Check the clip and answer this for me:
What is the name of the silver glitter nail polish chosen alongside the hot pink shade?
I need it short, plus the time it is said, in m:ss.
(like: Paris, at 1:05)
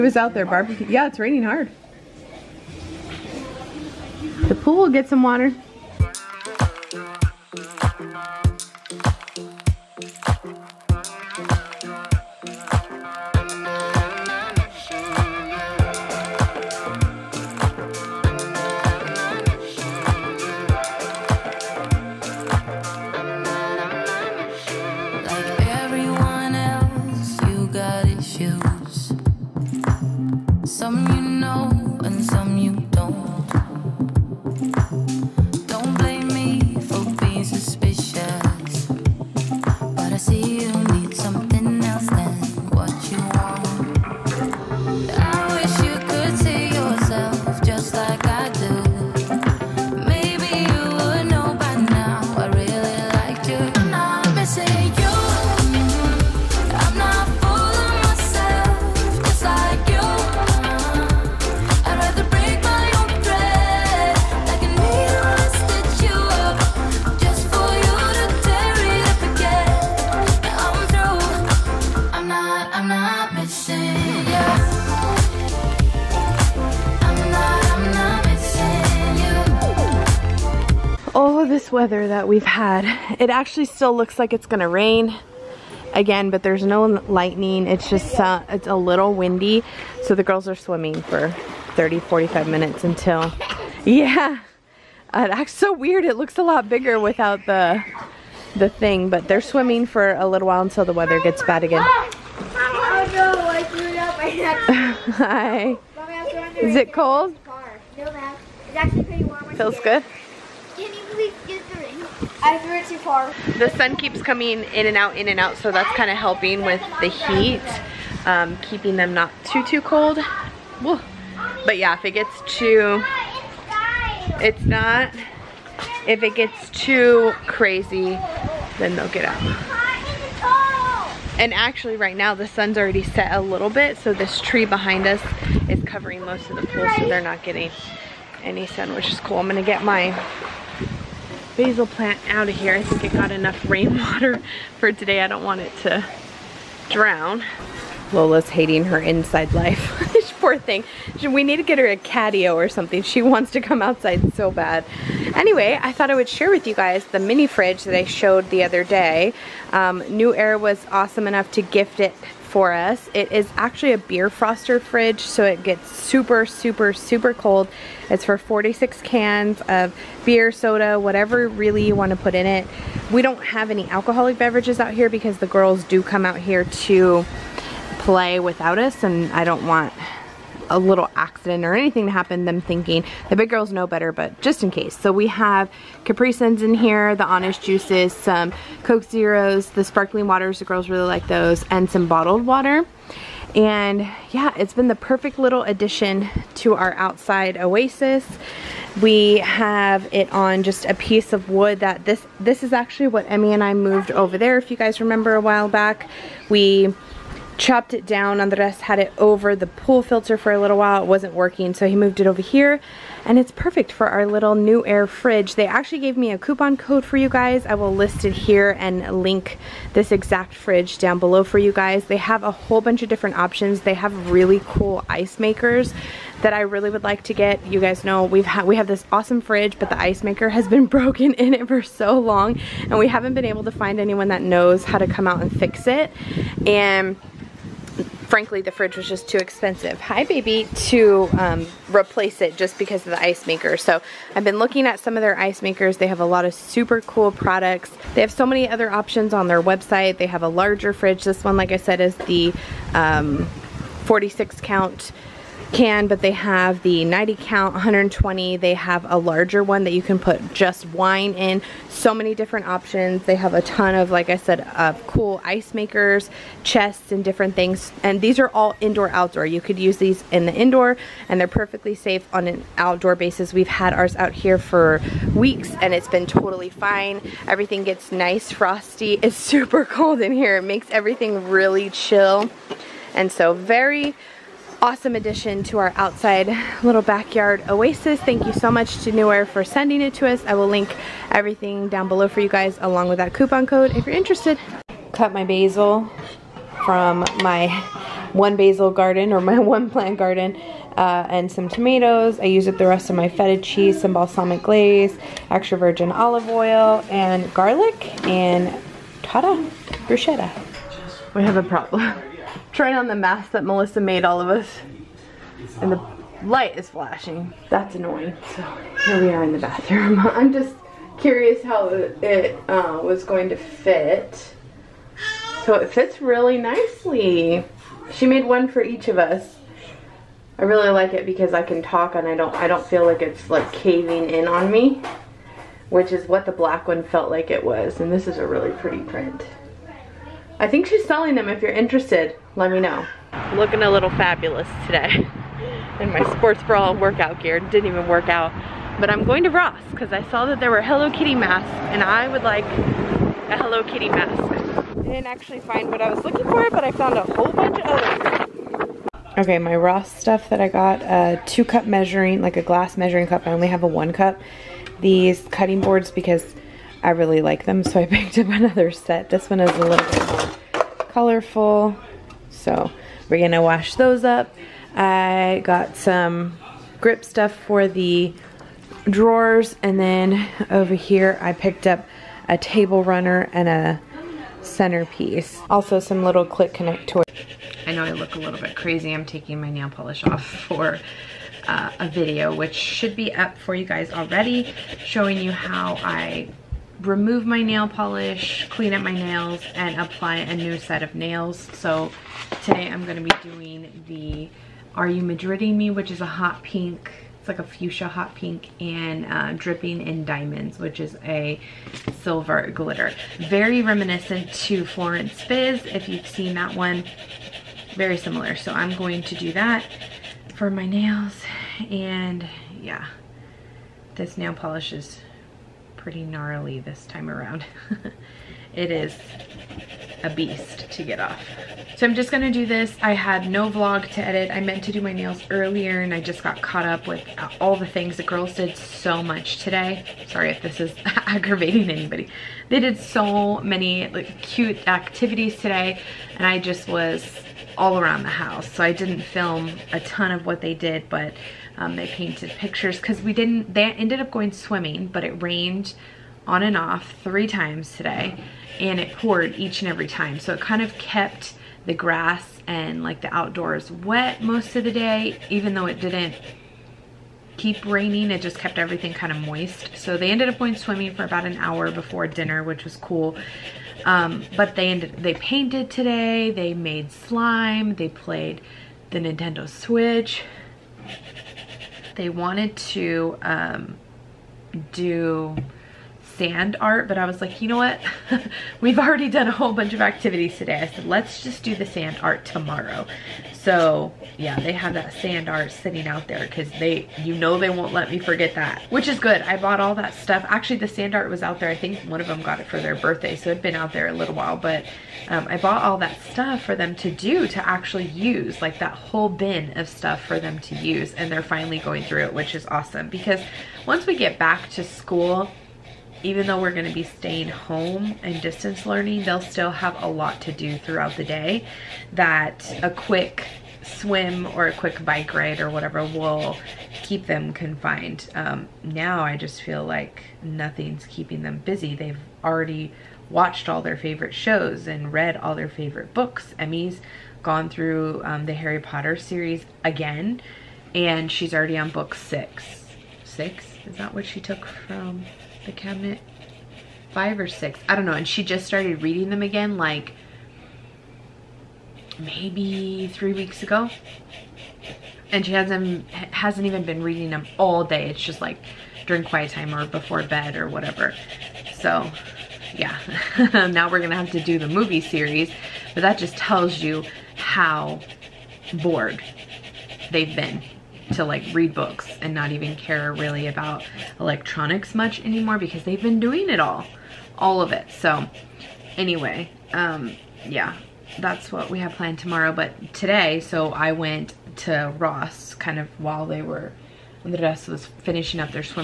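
Dripping in Diamonds, at 6:49.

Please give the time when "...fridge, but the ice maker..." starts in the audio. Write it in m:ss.
3:49.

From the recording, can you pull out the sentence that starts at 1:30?
So the girls are swimming for 30, 45 minutes until, yeah.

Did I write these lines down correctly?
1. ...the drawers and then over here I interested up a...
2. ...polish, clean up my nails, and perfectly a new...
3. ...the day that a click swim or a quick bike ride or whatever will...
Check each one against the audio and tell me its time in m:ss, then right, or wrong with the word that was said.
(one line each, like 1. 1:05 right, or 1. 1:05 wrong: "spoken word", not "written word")
1. 6:17 wrong: "picked", not "interested"
2. 6:37 wrong: "apply", not "perfectly"
3. 8:41 wrong: "quick", not "click".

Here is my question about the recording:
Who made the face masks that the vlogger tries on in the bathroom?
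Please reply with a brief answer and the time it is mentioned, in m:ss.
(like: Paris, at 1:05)
Melissa, at 5:13.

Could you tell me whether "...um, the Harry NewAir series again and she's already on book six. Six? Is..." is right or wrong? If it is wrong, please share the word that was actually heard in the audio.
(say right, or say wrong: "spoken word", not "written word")
wrong: "Potter", not "NewAir".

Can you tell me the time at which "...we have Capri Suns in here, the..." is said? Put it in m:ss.
3:05.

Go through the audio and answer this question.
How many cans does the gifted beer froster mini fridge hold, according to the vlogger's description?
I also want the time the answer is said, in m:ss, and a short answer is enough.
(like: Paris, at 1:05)
46, at 2:48.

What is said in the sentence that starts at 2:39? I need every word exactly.
Um, NewAir was awesome enough to gift it for us.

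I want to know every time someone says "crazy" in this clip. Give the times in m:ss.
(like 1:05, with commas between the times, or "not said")
2:07, 6:28.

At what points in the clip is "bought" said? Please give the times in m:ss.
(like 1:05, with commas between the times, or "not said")
8:19, 8:25.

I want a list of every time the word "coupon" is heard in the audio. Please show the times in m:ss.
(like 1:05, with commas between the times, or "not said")
3:36, 4:53.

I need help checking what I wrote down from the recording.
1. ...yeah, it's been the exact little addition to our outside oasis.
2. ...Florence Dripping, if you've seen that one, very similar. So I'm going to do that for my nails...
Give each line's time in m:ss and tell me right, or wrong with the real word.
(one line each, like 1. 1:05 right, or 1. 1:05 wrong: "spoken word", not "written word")
1. 3:14 wrong: "perfect", not "exact"
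2. 6:54 wrong: "Fizz", not "Dripping".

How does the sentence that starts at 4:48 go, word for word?
Thank you so much to NewAir for sending it to us.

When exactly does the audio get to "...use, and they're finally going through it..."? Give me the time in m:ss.
8:30.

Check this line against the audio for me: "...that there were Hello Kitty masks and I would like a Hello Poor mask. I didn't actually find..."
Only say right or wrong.
wrong.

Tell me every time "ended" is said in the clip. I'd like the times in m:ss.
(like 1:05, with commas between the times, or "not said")
7:33, 7:50, 7:54.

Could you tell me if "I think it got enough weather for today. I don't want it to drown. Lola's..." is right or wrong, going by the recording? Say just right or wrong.
wrong.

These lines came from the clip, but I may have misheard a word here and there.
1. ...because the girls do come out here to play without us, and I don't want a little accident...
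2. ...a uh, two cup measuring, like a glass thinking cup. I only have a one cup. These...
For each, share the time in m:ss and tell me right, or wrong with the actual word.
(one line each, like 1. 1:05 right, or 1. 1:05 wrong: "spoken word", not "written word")
1. 2:55 right
2. 6:01 wrong: "measuring", not "thinking".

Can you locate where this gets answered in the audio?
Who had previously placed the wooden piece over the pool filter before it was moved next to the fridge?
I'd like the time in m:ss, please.
3:28.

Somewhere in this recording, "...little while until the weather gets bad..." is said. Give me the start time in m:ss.
1:40.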